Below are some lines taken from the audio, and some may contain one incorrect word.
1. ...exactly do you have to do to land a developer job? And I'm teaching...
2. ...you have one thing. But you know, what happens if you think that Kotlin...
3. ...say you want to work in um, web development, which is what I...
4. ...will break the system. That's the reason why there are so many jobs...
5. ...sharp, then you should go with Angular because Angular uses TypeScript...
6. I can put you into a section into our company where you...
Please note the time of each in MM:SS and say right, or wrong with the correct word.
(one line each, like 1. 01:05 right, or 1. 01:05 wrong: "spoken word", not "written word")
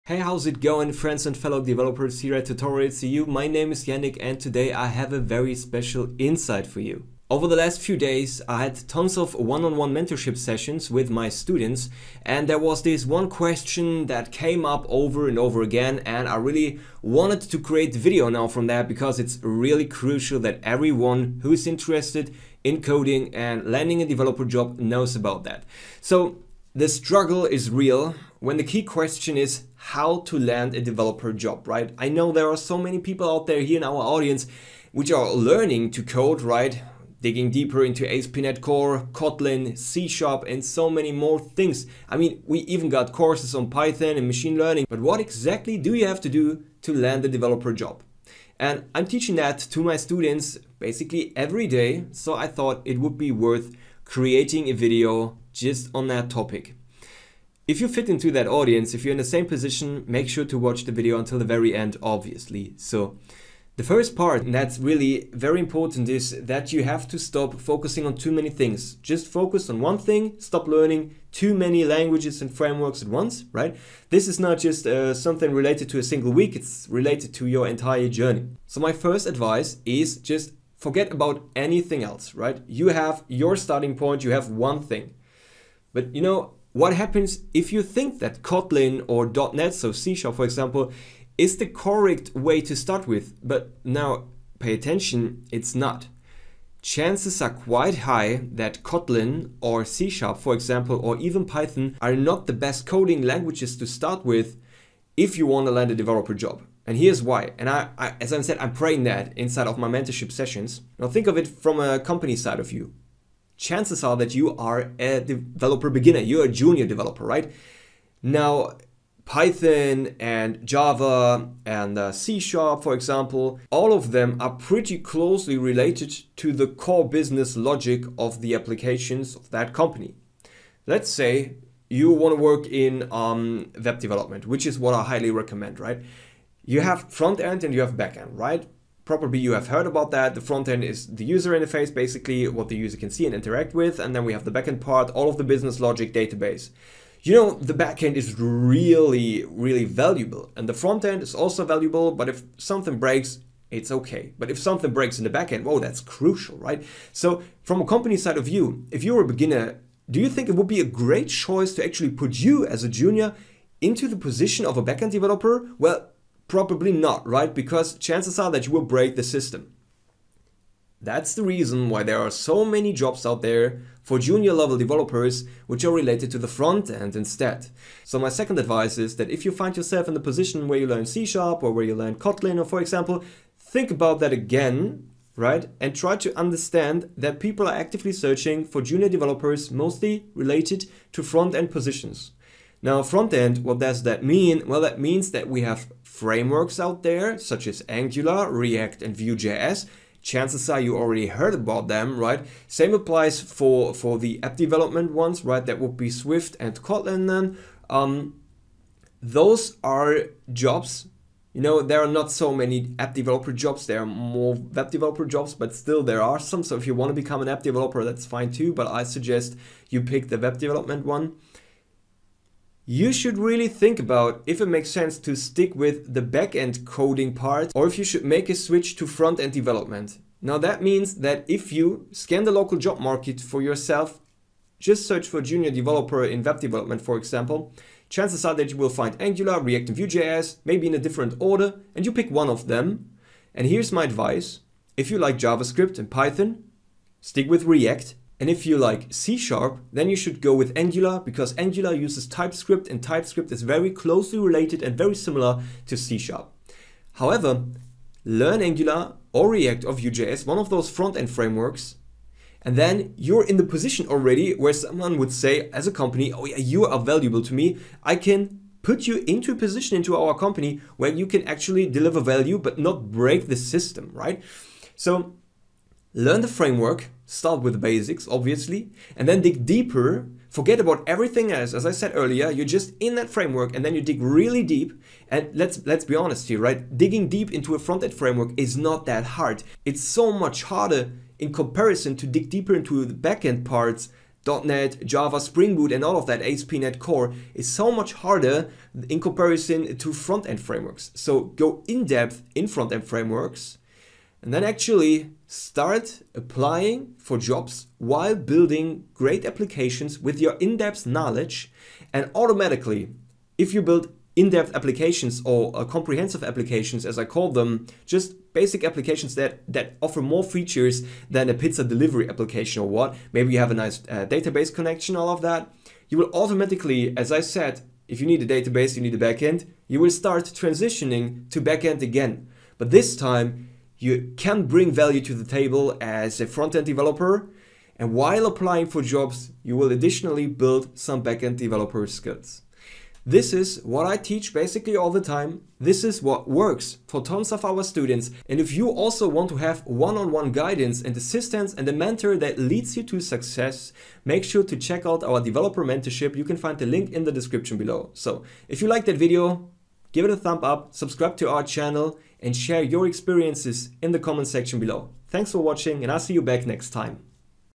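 1. 00:45 right
2. 01:24 right
3. 02:11 right
4. 02:48 right
5. 04:09 right
6. 04:28 wrong: "position", not "section".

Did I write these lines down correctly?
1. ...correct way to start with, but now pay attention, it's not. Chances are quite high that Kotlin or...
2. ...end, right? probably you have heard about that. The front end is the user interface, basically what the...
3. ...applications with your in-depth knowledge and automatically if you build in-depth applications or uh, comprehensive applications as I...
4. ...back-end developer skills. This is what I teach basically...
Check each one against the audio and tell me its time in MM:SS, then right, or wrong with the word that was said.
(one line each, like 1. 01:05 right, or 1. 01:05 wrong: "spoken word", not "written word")
1. 01:31 right
2. 02:18 right
3. 05:09 right
4. 05:41 right.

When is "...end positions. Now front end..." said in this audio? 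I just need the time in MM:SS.
03:11.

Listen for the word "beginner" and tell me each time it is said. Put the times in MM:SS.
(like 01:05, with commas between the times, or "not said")
01:55, 02:39.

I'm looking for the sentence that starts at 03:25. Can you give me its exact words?
That would be Swift and Kotlin then.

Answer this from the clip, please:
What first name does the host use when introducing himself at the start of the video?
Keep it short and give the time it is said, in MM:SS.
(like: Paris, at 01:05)
Yannick, at 00:03.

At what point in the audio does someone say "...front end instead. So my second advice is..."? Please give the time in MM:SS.
02:56.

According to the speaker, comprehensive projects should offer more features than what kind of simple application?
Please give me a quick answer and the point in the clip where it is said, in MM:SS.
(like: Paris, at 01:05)
pizza delivery application, at 05:21.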